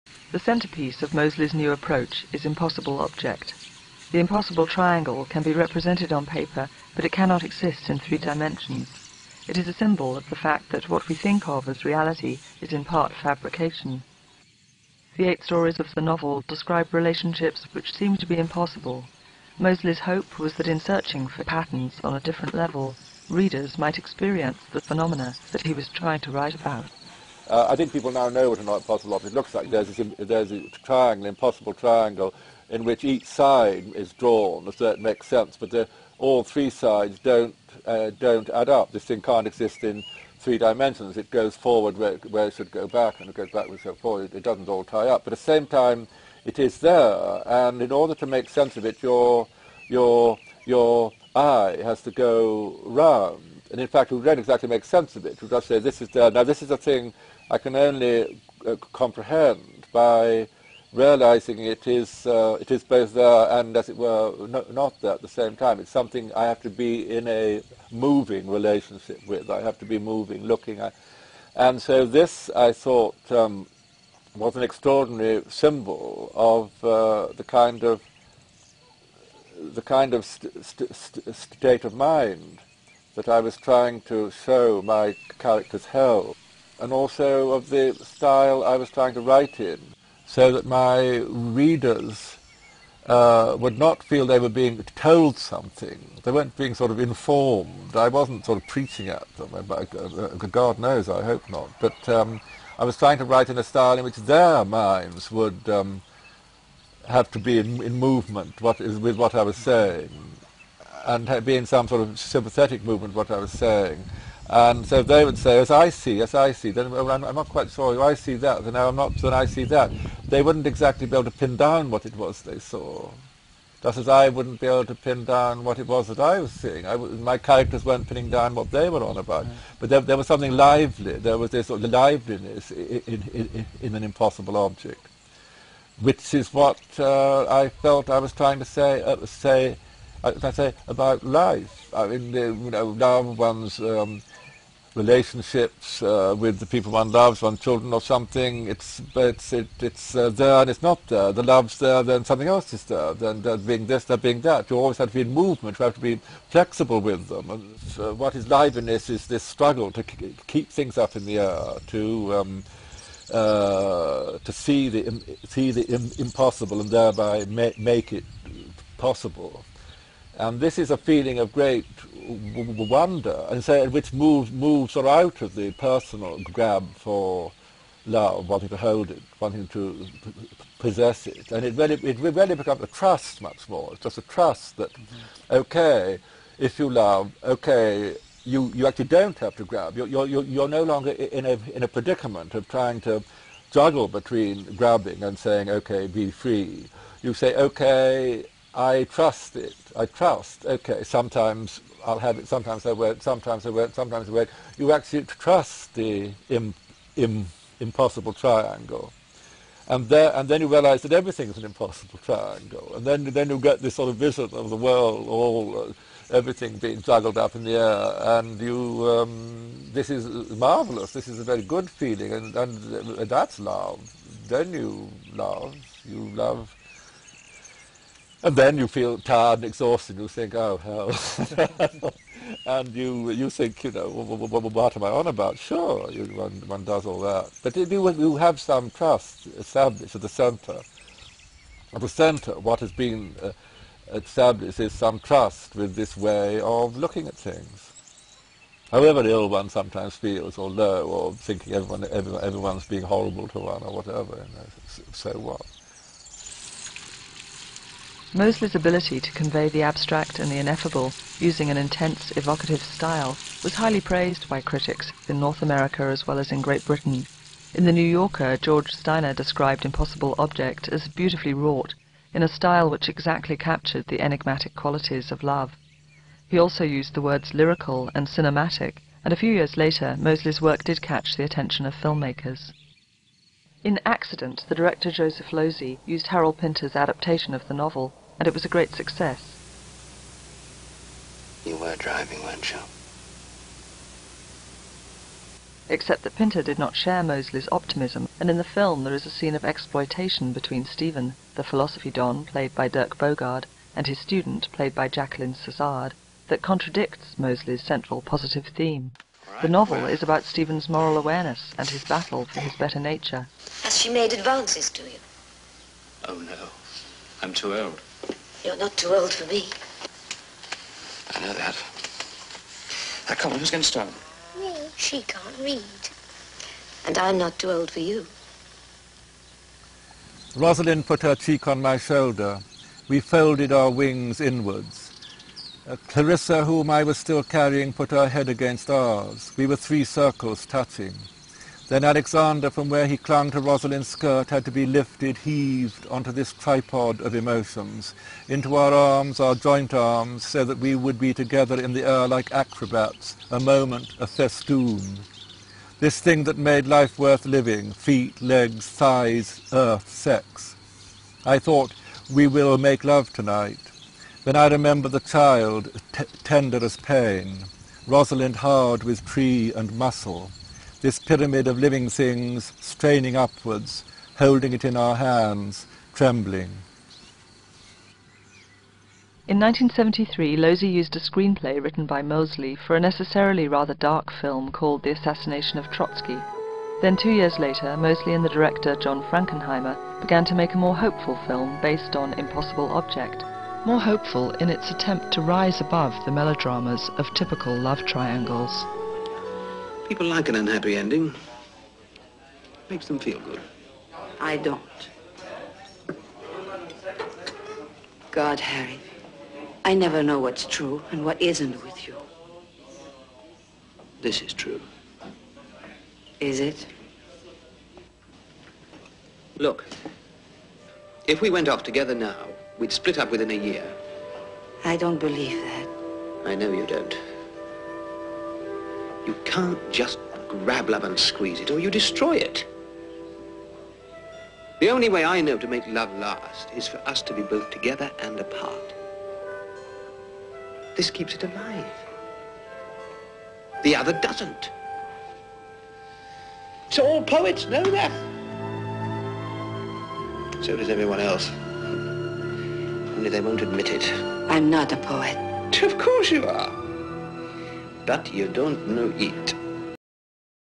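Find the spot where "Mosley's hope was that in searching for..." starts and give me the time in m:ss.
0:19.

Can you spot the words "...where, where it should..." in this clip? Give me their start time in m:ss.
0:41.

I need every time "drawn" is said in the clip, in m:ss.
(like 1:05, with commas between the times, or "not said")
0:34.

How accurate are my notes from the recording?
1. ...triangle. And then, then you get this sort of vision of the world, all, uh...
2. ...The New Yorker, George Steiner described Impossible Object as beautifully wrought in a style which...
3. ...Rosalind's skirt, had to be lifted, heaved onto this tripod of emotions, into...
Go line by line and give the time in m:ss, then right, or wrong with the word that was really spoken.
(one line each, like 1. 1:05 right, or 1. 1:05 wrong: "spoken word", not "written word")
1. 3:32 right
2. 4:27 right
3. 5:43 right.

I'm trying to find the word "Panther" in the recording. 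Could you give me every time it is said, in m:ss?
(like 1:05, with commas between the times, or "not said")
not said.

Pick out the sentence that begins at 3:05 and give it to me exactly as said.
okay, if you love, okay, you, you actually don't have to grab.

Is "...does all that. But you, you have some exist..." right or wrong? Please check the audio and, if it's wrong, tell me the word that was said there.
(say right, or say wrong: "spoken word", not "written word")
wrong: "trust", not "exist".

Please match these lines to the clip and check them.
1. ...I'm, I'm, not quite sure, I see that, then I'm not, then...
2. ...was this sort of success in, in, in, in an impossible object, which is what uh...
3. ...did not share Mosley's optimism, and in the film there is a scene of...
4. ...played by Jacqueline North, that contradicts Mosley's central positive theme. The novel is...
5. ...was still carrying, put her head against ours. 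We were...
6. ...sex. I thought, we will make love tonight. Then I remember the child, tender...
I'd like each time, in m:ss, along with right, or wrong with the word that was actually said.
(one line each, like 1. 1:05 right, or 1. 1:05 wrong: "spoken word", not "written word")
1. 1:57 right
2. 2:11 wrong: "liveliness", not "success"
3. 4:56 right
4. 5:04 wrong: "Sassard", not "North"
5. 5:37 right
6. 6:00 right.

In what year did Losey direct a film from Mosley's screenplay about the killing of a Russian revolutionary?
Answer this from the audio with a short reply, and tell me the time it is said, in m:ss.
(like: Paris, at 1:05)
1973, at 6:19.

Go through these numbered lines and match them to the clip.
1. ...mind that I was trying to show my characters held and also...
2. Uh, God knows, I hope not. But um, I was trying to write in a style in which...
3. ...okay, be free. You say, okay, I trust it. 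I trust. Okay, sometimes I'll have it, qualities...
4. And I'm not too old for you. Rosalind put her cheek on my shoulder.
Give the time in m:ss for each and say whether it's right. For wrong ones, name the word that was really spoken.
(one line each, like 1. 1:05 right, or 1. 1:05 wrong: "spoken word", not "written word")
1. 1:21 right
2. 1:39 right
3. 3:15 wrong: "sometimes", not "qualities"
4. 5:27 right.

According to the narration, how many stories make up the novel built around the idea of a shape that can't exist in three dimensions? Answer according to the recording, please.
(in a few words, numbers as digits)
8.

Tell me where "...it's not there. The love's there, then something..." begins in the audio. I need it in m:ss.
2:30.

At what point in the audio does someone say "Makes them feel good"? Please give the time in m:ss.
6:42.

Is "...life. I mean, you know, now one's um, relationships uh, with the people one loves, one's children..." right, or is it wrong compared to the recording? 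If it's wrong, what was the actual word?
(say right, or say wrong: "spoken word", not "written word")
right.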